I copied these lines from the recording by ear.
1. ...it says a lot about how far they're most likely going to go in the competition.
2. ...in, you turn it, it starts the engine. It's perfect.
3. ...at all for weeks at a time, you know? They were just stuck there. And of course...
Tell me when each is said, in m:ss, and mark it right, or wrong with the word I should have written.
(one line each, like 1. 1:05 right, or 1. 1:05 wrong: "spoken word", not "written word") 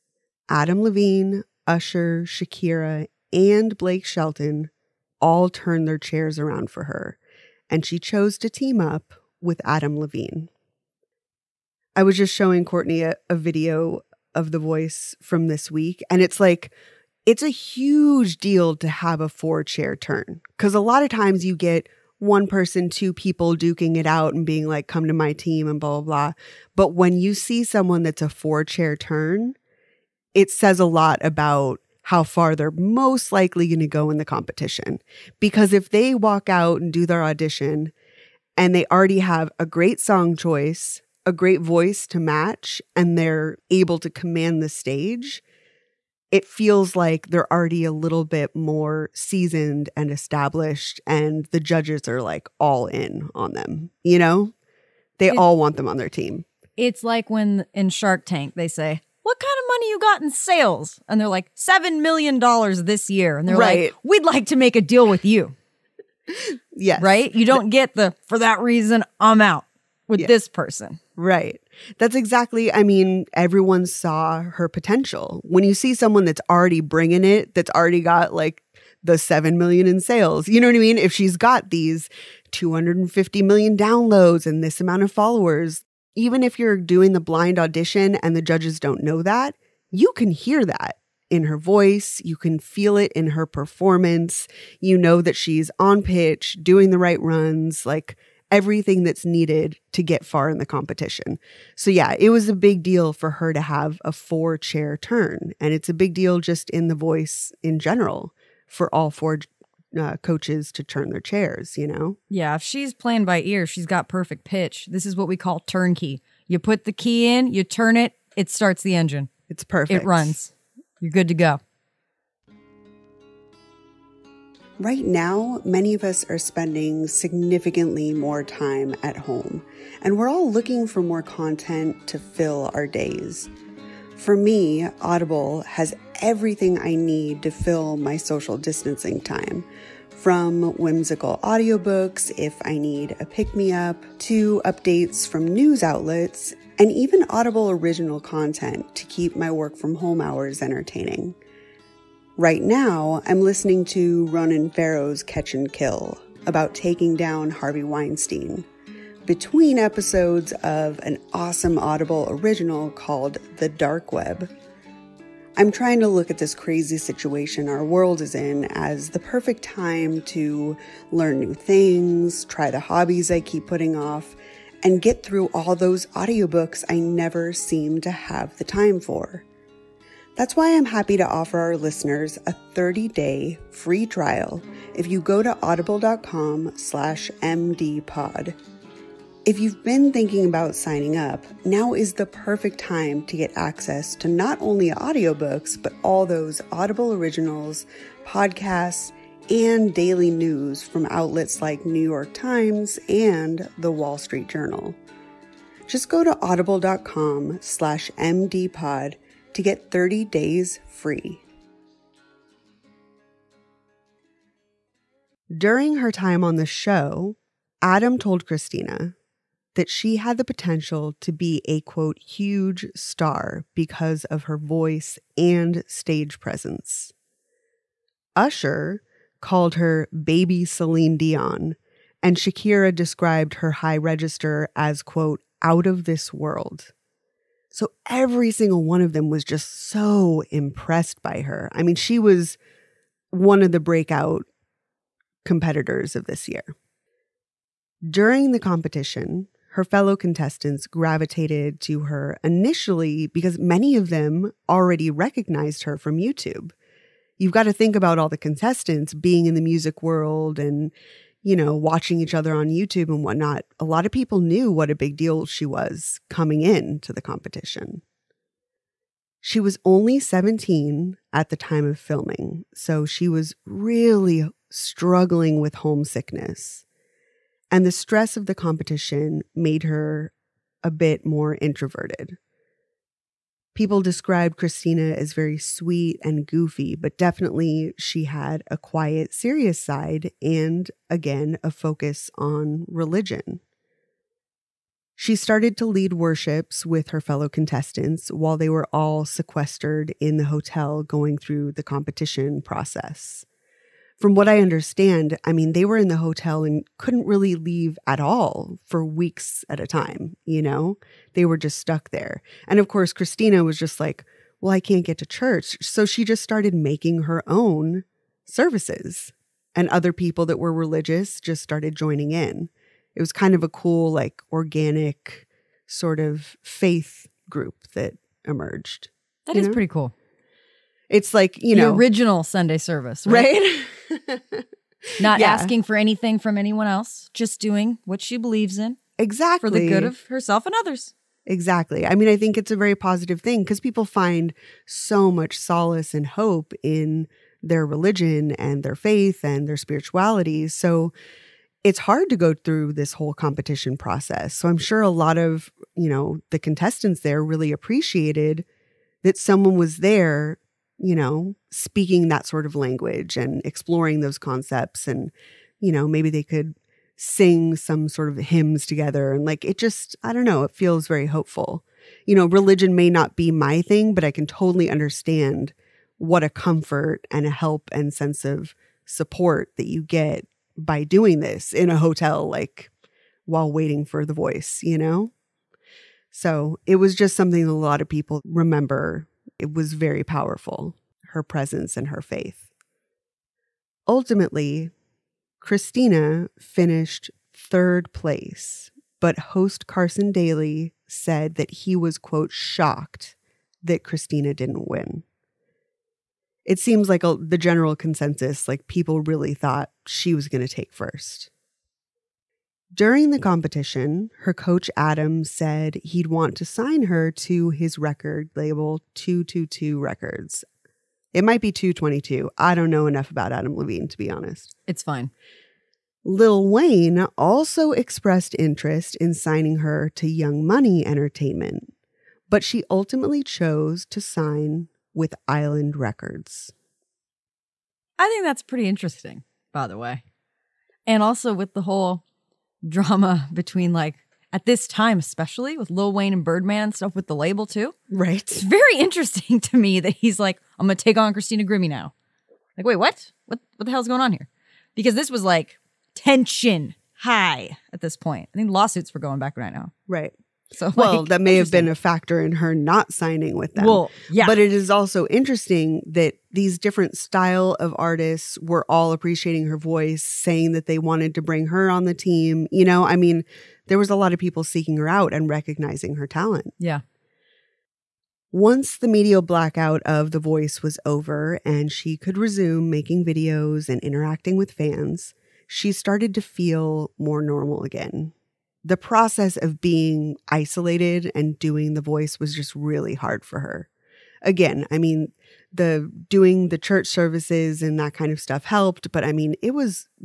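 1. 0:30 right
2. 1:57 right
3. 5:08 right.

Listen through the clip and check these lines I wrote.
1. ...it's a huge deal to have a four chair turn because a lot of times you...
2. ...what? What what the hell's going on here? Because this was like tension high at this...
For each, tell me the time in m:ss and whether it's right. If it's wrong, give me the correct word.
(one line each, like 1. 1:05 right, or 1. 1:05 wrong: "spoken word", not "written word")
1. 0:17 right
2. 7:32 right.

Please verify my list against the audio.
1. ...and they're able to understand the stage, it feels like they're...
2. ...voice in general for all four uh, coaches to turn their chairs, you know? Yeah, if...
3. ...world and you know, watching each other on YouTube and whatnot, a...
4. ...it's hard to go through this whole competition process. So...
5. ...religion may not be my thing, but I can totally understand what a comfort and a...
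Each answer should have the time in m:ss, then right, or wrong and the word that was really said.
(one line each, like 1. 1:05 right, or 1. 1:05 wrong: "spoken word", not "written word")
1. 0:42 wrong: "command", not "understand"
2. 1:46 right
3. 4:20 right
4. 5:51 right
5. 6:12 right.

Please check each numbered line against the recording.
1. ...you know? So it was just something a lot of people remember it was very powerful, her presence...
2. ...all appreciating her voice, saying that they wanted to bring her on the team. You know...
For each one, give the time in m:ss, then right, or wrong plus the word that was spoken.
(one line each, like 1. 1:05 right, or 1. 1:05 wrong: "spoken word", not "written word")
1. 6:24 right
2. 7:48 right.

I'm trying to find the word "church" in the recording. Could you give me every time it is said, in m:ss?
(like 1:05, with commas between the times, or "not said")
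5:15, 8:16.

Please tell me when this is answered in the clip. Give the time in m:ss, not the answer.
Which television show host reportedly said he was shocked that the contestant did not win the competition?
6:39.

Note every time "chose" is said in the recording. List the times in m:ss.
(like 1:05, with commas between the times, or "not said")
0:07, 7:13.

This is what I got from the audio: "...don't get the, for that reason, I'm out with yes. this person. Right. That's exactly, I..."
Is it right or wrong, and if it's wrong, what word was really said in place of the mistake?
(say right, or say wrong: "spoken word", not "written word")
right.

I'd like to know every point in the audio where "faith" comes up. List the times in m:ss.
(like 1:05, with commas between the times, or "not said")
5:26, 5:48, 6:32.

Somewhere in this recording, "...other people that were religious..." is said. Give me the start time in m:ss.
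5:19.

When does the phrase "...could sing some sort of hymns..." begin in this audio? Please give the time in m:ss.
6:06.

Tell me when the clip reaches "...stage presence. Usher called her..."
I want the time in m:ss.
3:45.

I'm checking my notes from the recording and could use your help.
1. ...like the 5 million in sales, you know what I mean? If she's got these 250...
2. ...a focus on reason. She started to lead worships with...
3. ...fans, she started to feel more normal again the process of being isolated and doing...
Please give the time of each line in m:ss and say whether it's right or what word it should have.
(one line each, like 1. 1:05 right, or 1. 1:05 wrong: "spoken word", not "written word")
1. 1:18 wrong: "7", not "5"
2. 4:51 wrong: "religion", not "reason"
3. 8:04 right.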